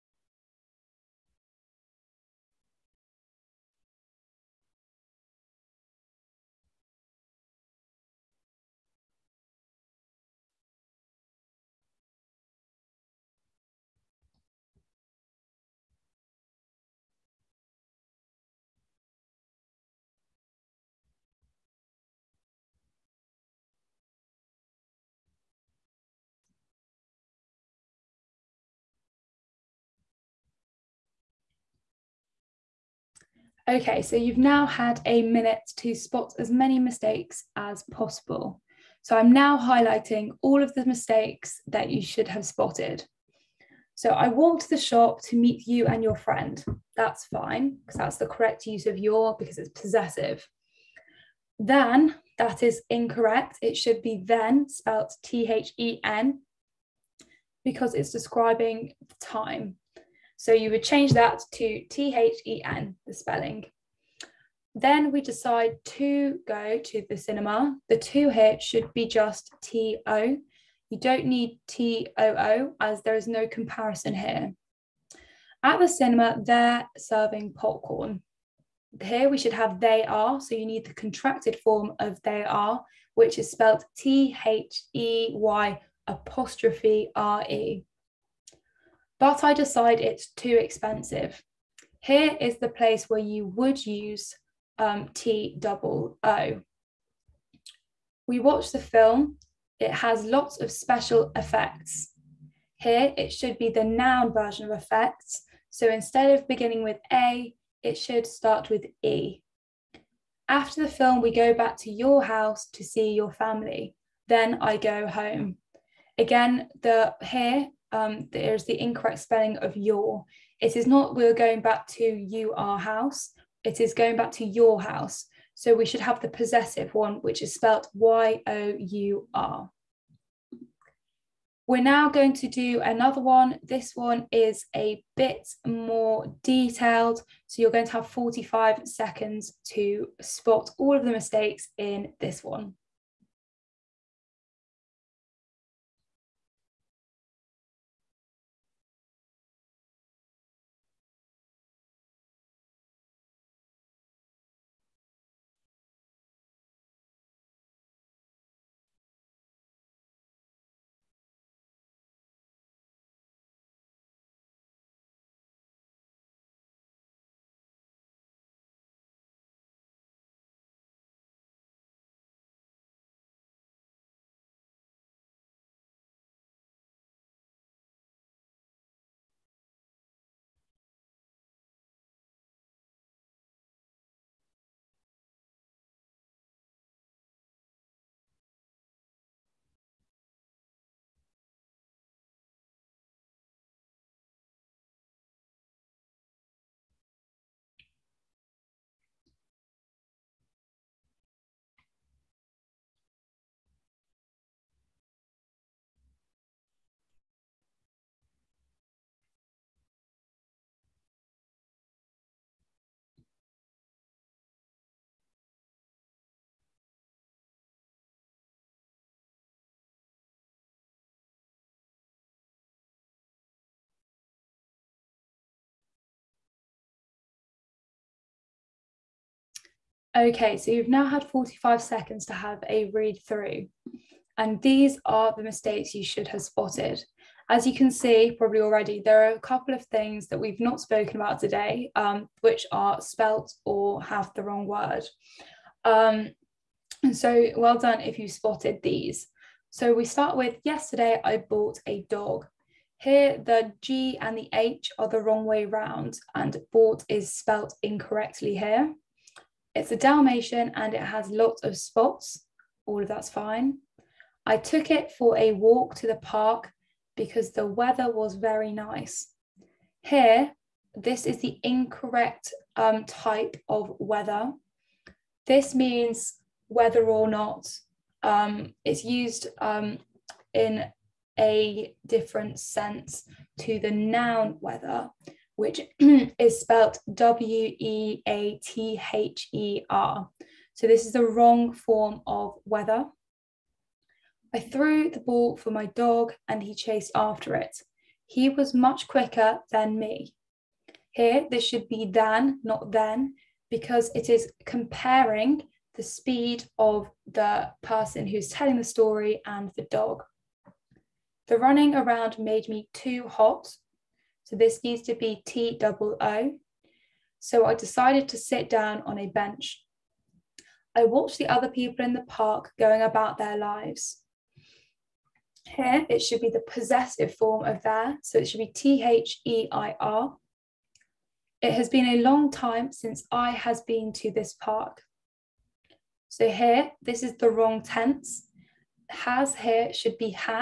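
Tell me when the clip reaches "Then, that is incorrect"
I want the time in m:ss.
0:51.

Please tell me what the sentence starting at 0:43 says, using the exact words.
So I walked the shop to meet you and your friend.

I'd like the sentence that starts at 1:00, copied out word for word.
So you would change that to T H E N, the spelling.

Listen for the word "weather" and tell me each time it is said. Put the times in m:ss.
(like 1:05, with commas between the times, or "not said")
4:27, 4:33, 4:44, 4:52.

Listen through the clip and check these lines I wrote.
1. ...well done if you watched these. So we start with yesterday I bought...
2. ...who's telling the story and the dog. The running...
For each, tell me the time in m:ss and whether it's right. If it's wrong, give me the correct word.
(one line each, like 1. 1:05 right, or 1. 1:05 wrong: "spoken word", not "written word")
1. 4:07 wrong: "spotted", not "watched"
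2. 5:08 right.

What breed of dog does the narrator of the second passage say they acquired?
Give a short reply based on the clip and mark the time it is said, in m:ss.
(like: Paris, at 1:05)
Dalmatian, at 4:19.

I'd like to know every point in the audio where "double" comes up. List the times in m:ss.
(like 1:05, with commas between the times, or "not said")
1:35, 5:15.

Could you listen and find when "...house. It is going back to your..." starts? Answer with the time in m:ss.
2:02.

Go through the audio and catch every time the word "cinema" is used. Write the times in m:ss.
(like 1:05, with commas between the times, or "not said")
1:07, 1:15.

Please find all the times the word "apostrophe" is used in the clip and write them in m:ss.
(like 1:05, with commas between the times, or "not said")
1:26.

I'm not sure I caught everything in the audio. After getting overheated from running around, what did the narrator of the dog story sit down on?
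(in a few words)
a bench.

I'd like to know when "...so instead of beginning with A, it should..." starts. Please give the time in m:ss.
1:45.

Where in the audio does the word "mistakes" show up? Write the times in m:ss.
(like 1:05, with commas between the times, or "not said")
0:36, 0:40, 2:21, 3:55.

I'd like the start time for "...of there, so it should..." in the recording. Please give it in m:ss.
5:27.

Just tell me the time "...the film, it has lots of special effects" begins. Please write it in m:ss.
1:38.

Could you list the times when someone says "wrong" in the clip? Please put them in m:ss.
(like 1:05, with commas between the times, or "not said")
4:04, 4:15, 4:51, 5:37.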